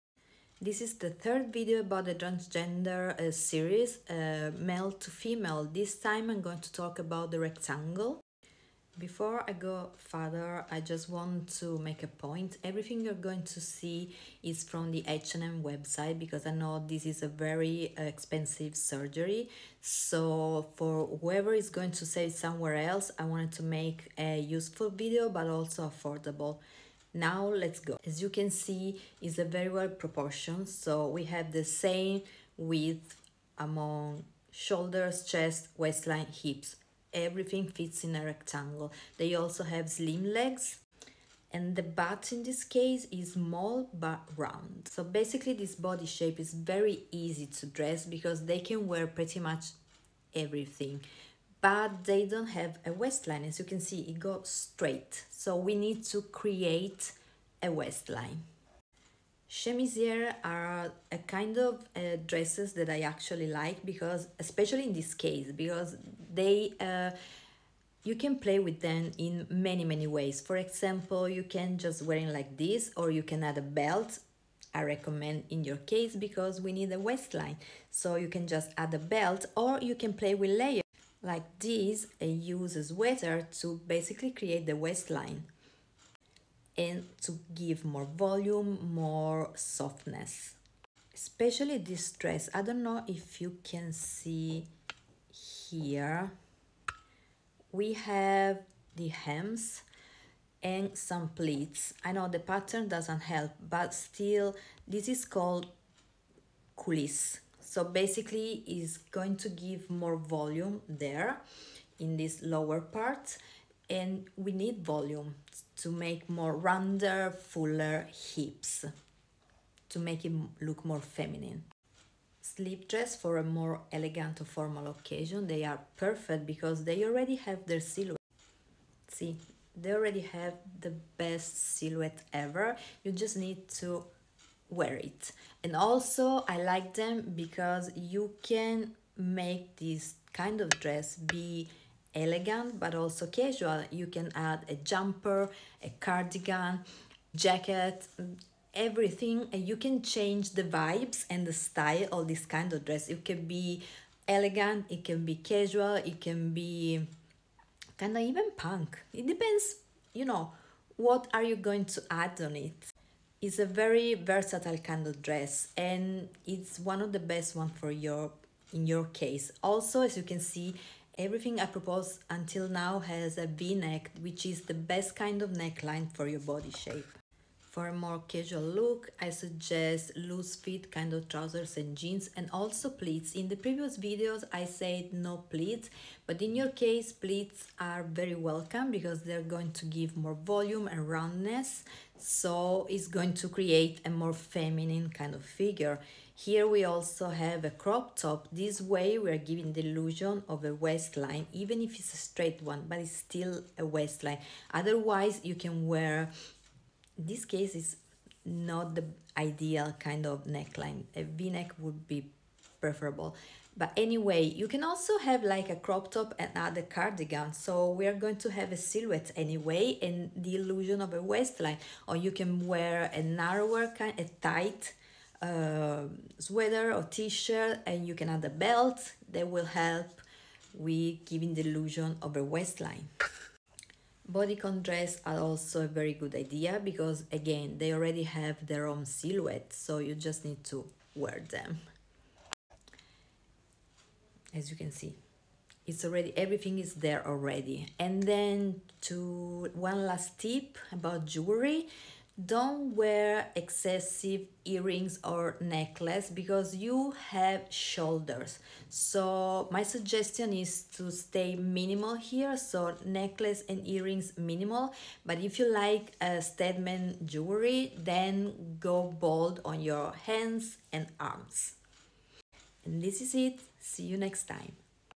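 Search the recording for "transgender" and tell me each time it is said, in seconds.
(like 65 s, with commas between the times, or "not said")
2 s.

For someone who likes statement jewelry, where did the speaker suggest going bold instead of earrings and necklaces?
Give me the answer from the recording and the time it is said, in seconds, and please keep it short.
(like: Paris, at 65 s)
hands and arms, at 270 s.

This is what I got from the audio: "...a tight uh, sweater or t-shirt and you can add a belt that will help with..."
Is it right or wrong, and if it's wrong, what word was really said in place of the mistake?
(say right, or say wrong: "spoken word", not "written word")
right.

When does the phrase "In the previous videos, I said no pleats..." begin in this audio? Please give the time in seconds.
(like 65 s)
183 s.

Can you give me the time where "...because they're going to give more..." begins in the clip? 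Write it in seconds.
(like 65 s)
188 s.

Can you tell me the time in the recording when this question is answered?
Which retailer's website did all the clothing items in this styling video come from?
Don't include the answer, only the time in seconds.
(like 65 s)
15 s.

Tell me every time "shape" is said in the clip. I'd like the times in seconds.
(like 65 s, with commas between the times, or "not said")
46 s, 176 s.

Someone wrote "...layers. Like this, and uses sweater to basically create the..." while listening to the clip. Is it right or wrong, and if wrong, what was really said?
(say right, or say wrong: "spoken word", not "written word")
right.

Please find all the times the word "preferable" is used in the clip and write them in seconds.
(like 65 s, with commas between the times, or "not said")
212 s.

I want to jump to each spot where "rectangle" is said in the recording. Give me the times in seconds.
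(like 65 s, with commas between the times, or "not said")
7 s, 38 s.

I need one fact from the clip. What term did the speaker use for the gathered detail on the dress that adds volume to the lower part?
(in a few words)
coulisse.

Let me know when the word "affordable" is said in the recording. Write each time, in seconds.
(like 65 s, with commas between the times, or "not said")
25 s.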